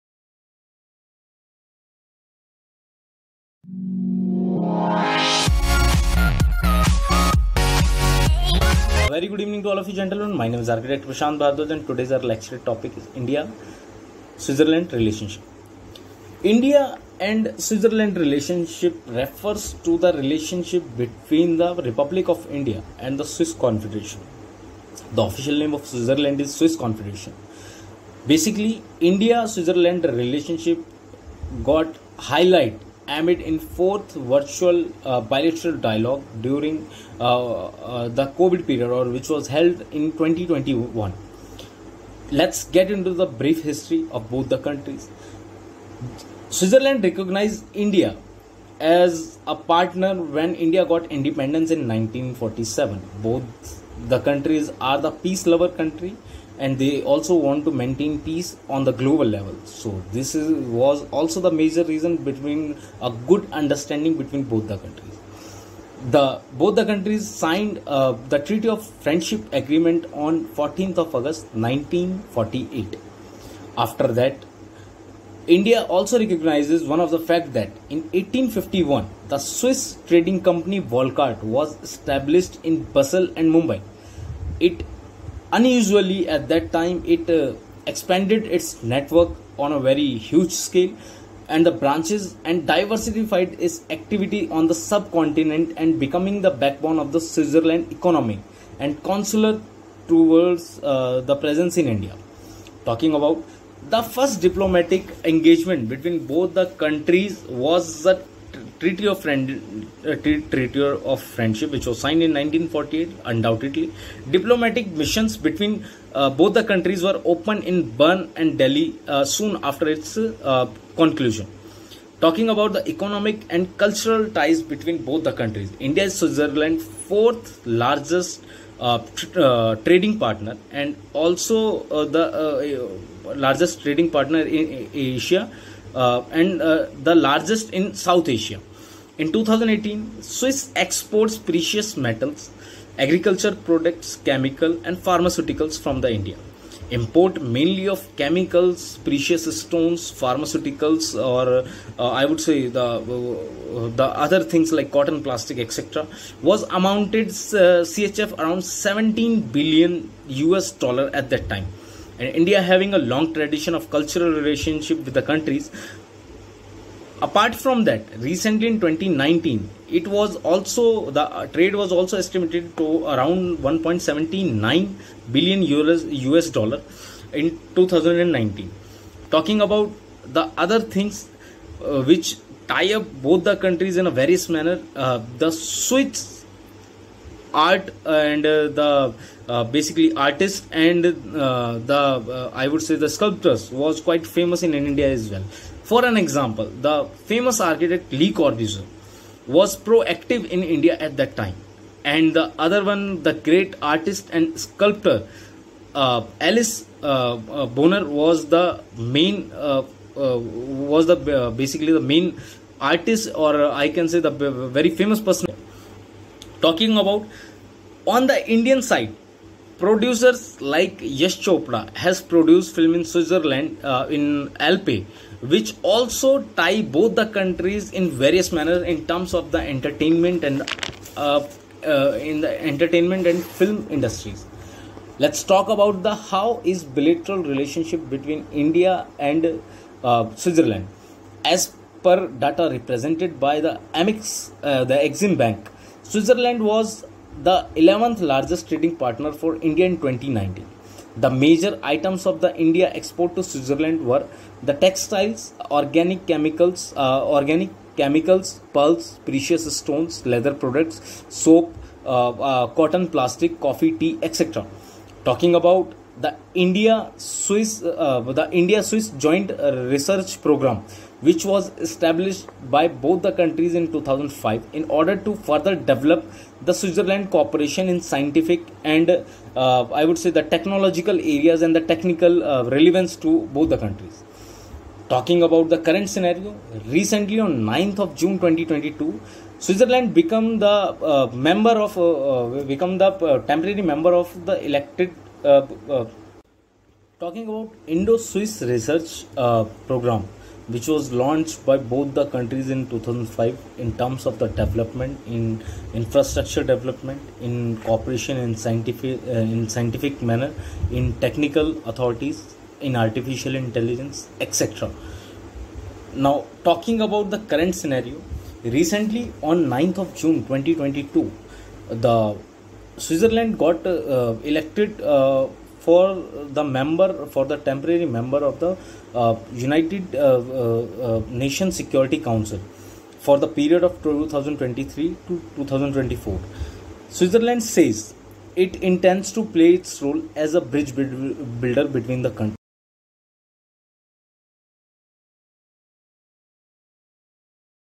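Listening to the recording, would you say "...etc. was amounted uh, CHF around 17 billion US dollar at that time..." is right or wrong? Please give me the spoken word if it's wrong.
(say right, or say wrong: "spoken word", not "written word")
right.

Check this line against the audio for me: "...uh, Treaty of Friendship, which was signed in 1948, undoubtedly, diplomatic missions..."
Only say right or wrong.
right.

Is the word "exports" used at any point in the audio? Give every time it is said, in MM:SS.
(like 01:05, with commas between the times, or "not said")
02:20, 04:12.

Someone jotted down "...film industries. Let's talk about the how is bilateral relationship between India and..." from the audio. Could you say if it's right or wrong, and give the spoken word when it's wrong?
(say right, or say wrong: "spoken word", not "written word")
right.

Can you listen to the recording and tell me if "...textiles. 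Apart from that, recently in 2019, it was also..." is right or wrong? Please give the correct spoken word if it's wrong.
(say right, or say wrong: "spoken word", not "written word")
wrong: "countries", not "textiles".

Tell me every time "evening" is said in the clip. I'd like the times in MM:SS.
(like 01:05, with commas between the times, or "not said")
00:09.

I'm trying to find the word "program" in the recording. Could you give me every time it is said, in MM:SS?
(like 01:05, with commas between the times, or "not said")
04:30, 04:59.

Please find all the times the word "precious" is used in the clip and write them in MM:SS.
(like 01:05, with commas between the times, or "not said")
02:21, 02:29, 04:19.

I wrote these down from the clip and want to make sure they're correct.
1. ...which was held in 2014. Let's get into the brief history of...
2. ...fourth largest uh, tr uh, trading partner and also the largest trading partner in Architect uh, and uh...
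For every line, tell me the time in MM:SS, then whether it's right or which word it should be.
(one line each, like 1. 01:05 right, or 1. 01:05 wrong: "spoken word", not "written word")
1. 00:39 wrong: "2021", not "2014"
2. 02:06 wrong: "Asia", not "Architect".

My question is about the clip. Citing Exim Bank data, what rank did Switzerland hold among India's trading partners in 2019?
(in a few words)
11th.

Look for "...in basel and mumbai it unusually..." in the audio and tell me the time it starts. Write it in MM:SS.
01:22.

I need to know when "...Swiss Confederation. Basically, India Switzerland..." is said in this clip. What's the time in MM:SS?
00:26.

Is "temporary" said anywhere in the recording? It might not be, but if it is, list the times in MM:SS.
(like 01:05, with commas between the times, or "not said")
04:53, 05:27.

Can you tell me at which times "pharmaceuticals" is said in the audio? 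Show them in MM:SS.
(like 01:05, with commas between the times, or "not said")
02:24, 02:30.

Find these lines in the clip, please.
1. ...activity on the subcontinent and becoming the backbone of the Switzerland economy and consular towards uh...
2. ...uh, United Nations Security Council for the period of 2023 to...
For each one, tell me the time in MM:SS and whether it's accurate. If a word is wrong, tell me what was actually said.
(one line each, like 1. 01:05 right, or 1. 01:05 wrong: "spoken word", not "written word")
1. 01:33 right
2. 05:29 right.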